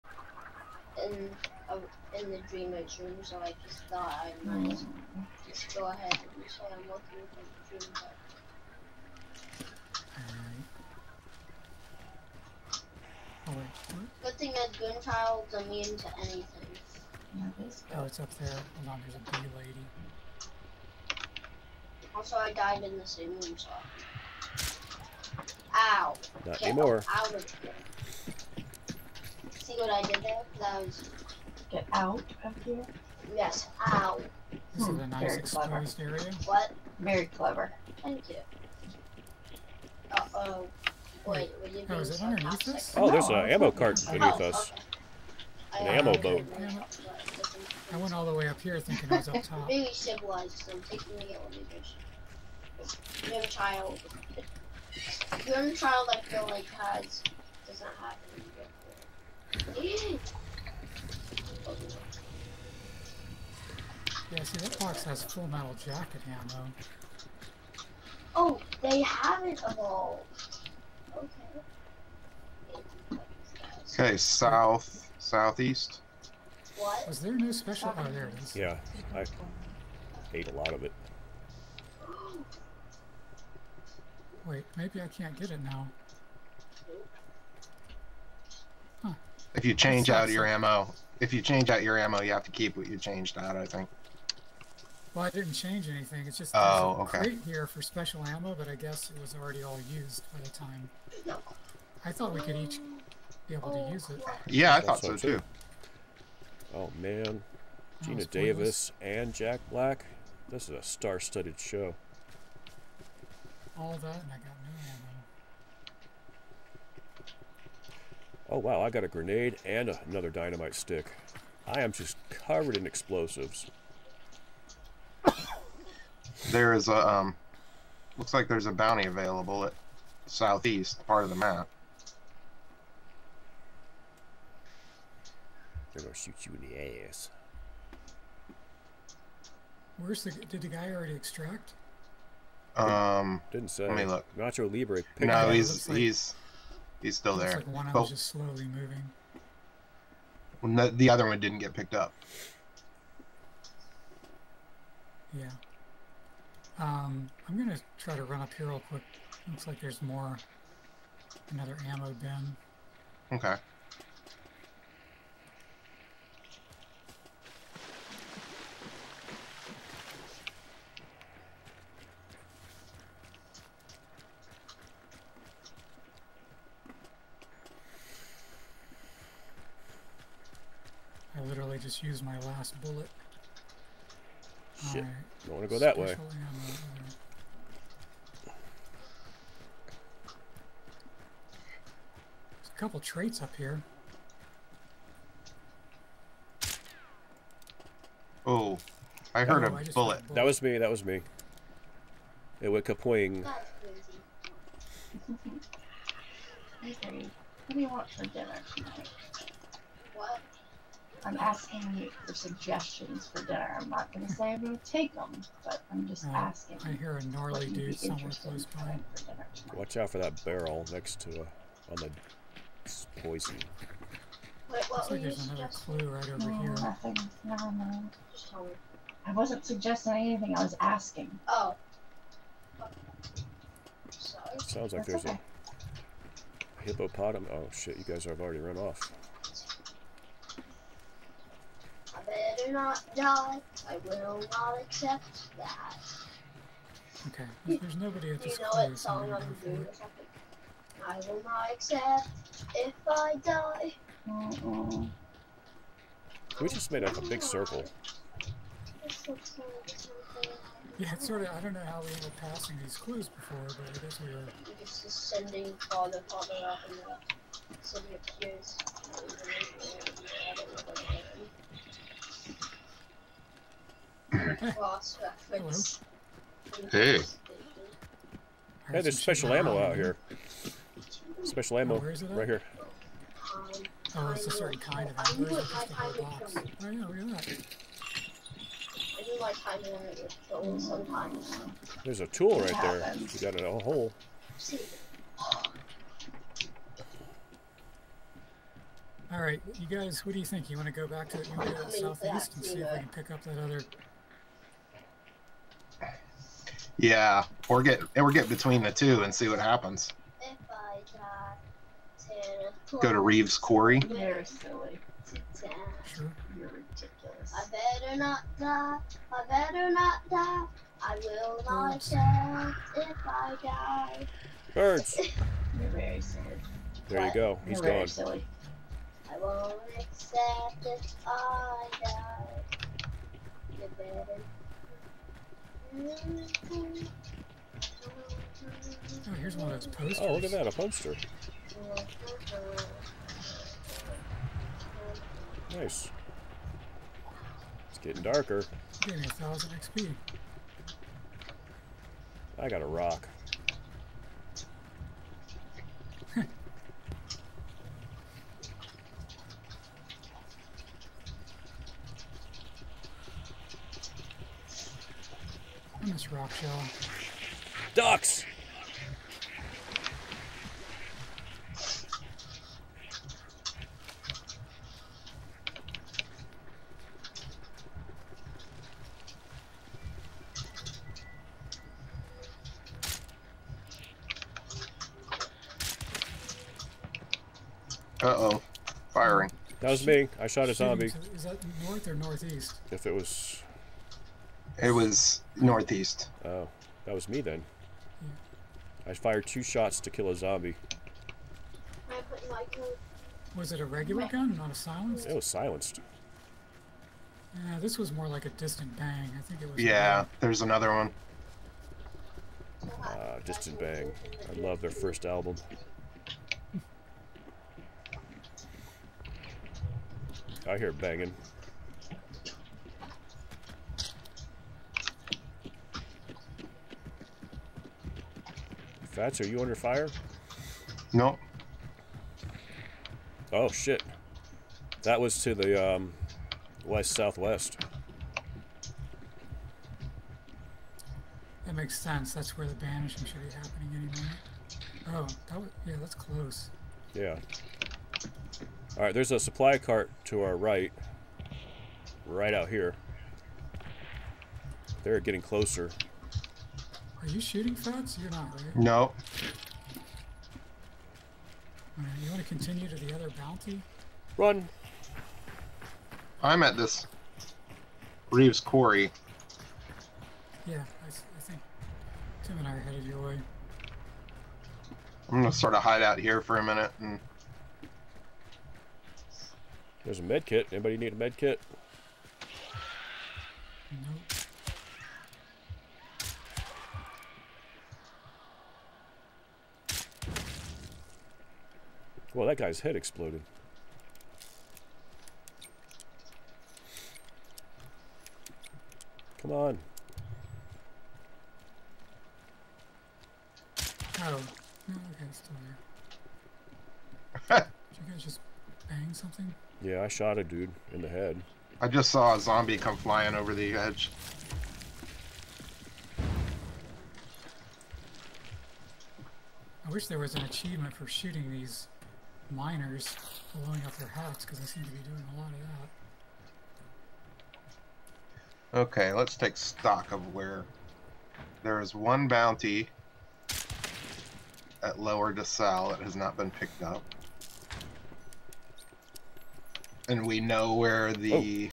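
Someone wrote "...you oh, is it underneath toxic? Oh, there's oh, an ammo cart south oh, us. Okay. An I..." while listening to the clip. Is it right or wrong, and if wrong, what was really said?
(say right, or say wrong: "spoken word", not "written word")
wrong: "beneath", not "south".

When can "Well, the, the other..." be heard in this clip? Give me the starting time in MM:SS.
02:30.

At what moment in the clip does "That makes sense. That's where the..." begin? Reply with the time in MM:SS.
07:21.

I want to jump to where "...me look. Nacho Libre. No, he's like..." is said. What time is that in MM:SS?
02:23.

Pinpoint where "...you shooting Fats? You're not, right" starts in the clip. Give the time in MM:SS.
07:37.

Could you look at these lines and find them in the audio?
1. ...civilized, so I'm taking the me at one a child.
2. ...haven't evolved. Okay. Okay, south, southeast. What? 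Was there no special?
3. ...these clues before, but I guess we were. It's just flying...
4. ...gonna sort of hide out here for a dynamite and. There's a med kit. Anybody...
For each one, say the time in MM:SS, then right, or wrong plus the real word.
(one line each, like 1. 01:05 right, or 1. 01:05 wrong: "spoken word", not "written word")
1. 00:49 right
2. 01:09 right
3. 04:22 wrong: "sending", not "flying"
4. 07:55 wrong: "minute", not "dynamite".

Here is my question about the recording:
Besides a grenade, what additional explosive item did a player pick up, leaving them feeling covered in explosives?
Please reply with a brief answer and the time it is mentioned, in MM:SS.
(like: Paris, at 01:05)
Dynamite stick, at 02:00.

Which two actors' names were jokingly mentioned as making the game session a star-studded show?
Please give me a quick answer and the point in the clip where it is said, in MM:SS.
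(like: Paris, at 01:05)
Geena Davis and Jack Black, at 01:48.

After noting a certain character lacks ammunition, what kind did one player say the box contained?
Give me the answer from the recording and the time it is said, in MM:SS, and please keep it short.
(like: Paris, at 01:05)
Full metal jacket, at 01:05.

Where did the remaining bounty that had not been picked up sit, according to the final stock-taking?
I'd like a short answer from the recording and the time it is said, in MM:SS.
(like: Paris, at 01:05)
Lower DeSalle, at 08:54.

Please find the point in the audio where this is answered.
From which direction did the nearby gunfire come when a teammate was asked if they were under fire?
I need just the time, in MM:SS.
07:16.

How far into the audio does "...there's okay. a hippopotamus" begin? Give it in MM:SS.
03:55.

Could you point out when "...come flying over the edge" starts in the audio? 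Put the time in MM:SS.
08:32.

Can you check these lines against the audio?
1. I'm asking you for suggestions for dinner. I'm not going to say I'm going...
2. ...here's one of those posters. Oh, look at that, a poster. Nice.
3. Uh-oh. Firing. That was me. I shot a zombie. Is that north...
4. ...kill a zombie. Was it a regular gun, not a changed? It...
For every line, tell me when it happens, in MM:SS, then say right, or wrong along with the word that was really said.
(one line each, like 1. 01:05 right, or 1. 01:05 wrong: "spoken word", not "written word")
1. 03:31 right
2. 05:39 right
3. 06:28 right
4. 06:40 wrong: "silenced", not "changed".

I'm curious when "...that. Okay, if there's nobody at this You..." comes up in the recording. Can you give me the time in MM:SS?
04:05.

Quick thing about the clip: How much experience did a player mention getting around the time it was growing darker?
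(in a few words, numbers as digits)
1000 XP.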